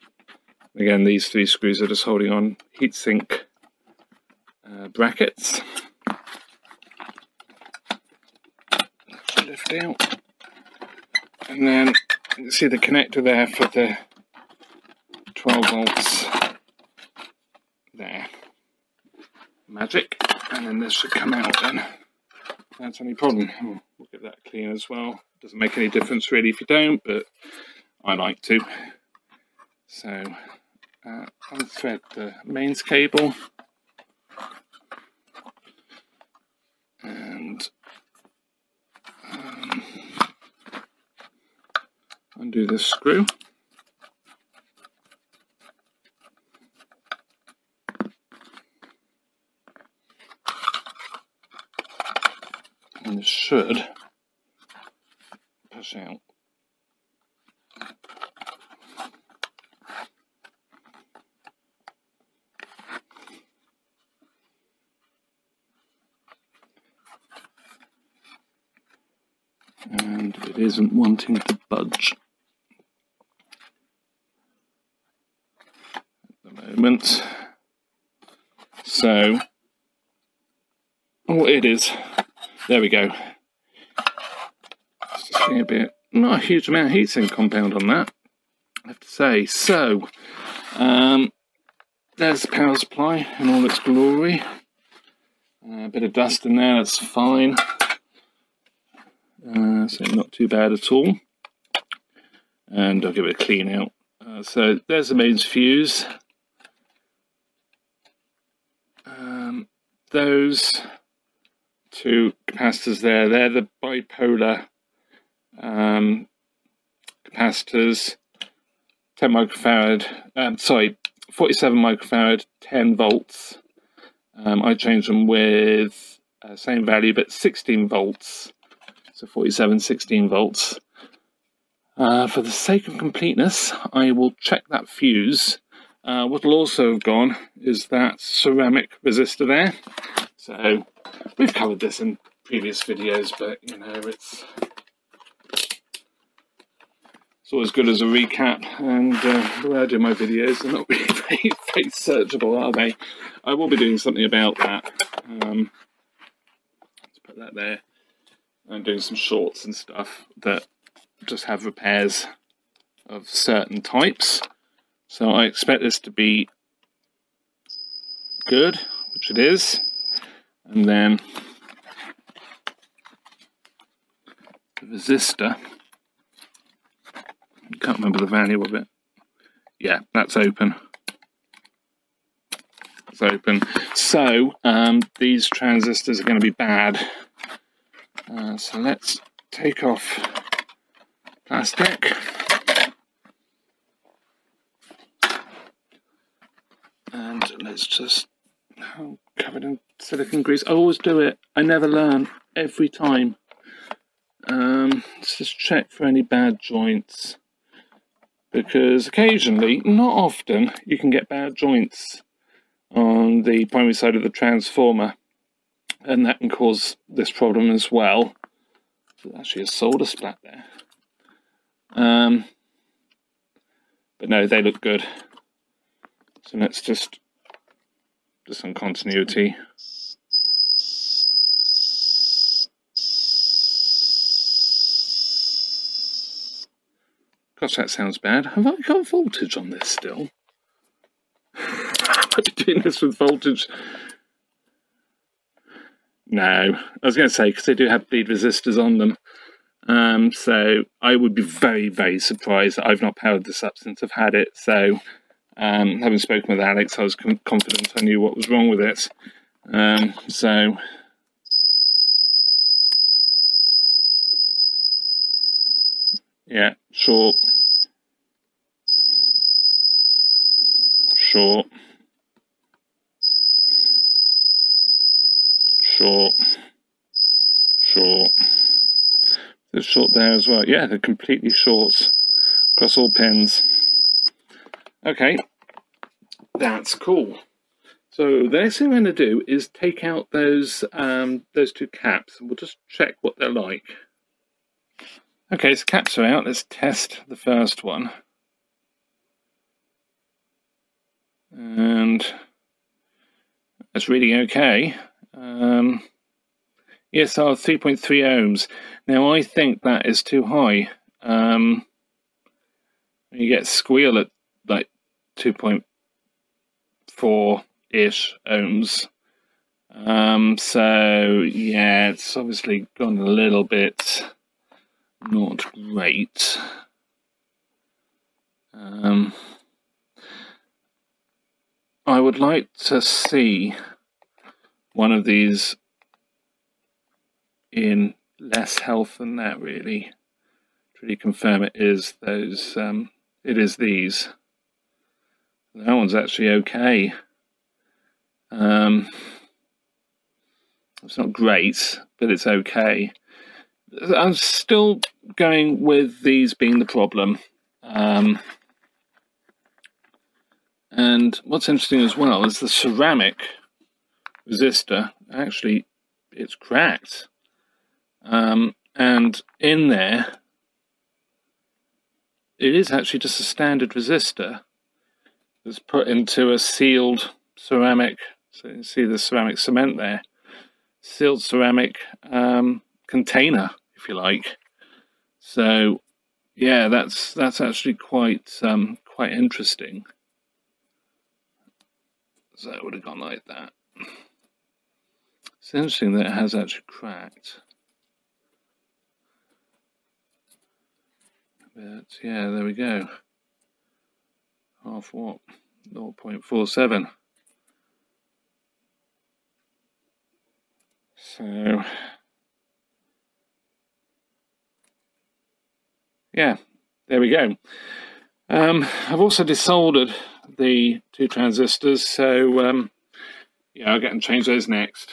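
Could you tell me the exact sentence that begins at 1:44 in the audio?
Uh, so there's the mains fuse.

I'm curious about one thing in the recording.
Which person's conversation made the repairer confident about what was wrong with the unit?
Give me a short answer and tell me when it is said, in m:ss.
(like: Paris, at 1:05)
Alex, at 4:16.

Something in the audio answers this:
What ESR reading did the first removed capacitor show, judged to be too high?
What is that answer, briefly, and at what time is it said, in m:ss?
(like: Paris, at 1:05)
3.3 ohms, at 5:07.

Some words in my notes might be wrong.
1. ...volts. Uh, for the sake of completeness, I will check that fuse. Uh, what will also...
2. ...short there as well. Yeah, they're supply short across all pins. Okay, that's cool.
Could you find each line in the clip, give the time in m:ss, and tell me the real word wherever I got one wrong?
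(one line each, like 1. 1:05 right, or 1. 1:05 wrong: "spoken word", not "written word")
1. 2:10 right
2. 4:39 wrong: "completely", not "supply".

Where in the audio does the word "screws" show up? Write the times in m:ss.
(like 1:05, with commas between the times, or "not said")
0:01, 0:42.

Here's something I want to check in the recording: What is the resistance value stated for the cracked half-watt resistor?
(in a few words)
0.47.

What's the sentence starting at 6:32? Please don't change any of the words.
So it would have gone like that.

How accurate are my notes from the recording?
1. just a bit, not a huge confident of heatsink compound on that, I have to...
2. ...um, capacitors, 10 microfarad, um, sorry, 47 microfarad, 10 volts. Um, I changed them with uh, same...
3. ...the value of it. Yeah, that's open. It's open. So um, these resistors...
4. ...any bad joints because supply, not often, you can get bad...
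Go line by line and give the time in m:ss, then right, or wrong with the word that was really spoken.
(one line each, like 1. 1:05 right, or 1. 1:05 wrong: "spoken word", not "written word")
1. 1:25 wrong: "amount", not "confident"
2. 1:55 right
3. 2:58 wrong: "transistors", not "resistors"
4. 3:26 wrong: "occasionally", not "supply".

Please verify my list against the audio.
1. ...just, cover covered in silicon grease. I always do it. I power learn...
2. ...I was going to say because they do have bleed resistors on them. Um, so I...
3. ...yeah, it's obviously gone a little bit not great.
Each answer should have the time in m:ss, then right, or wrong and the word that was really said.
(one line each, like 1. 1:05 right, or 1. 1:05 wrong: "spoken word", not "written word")
1. 3:17 wrong: "never", not "power"
2. 4:06 right
3. 5:21 right.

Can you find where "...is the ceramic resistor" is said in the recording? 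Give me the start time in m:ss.
6:02.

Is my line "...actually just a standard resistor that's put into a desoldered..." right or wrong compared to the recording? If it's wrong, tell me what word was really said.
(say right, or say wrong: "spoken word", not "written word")
wrong: "sealed", not "desoldered".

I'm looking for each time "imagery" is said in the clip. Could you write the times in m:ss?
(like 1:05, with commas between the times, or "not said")
not said.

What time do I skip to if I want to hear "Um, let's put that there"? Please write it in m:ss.
2:35.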